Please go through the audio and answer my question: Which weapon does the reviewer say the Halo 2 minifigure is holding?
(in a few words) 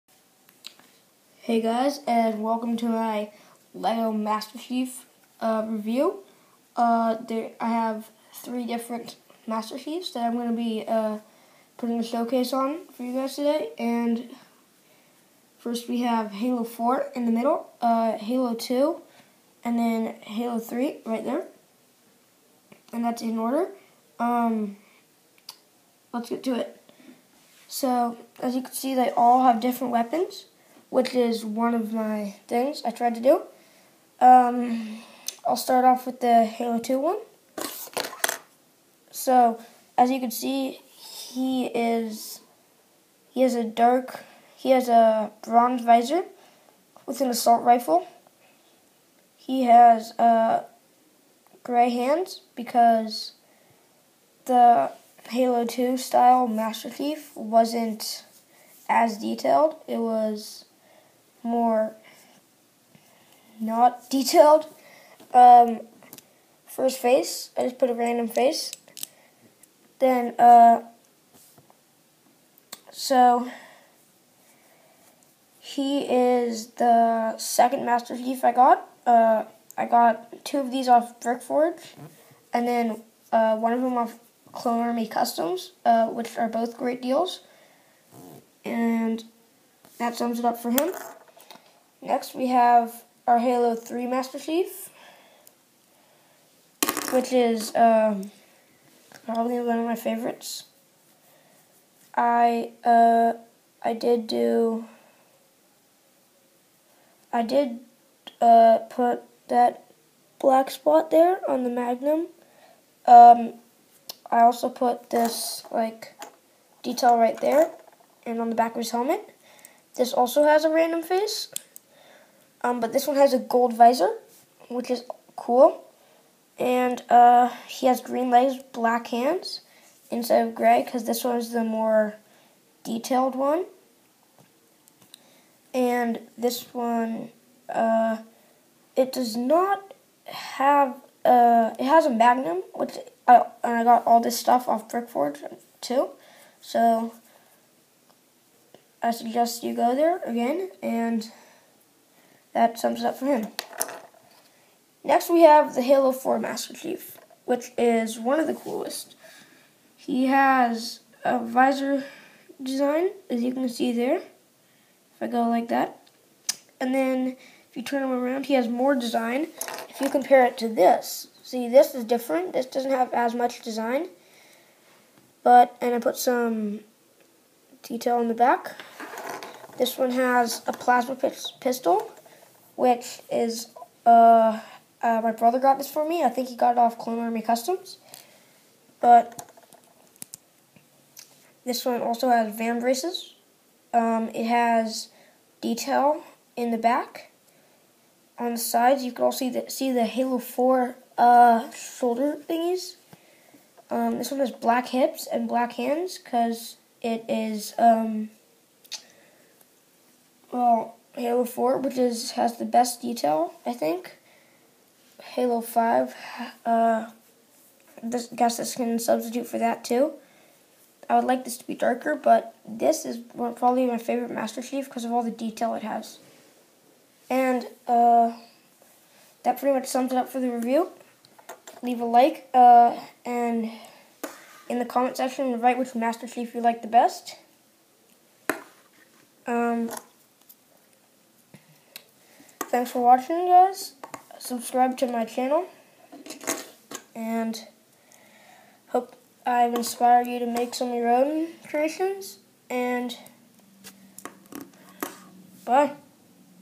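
Assault rifle.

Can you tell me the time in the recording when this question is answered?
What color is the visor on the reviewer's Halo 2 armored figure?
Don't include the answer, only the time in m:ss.
0:45.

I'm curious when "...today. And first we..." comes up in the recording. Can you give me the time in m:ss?
0:13.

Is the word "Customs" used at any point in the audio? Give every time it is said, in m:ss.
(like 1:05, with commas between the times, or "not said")
1:25, 3:07.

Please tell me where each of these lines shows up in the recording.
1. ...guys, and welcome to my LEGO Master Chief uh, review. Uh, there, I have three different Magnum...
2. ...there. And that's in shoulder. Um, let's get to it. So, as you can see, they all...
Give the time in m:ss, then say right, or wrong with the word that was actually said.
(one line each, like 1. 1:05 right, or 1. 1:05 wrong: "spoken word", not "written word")
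1. 0:01 wrong: "Master", not "Magnum"
2. 0:21 wrong: "order", not "shoulder".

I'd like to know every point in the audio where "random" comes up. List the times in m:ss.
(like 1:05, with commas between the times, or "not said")
1:07, 2:00.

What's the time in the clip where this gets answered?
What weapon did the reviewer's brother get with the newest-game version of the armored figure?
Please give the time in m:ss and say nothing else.
3:00.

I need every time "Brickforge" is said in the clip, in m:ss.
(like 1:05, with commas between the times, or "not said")
1:21, 2:24.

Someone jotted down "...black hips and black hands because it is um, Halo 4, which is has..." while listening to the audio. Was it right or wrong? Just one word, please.
right.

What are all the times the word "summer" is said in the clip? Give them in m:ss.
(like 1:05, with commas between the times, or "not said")
not said.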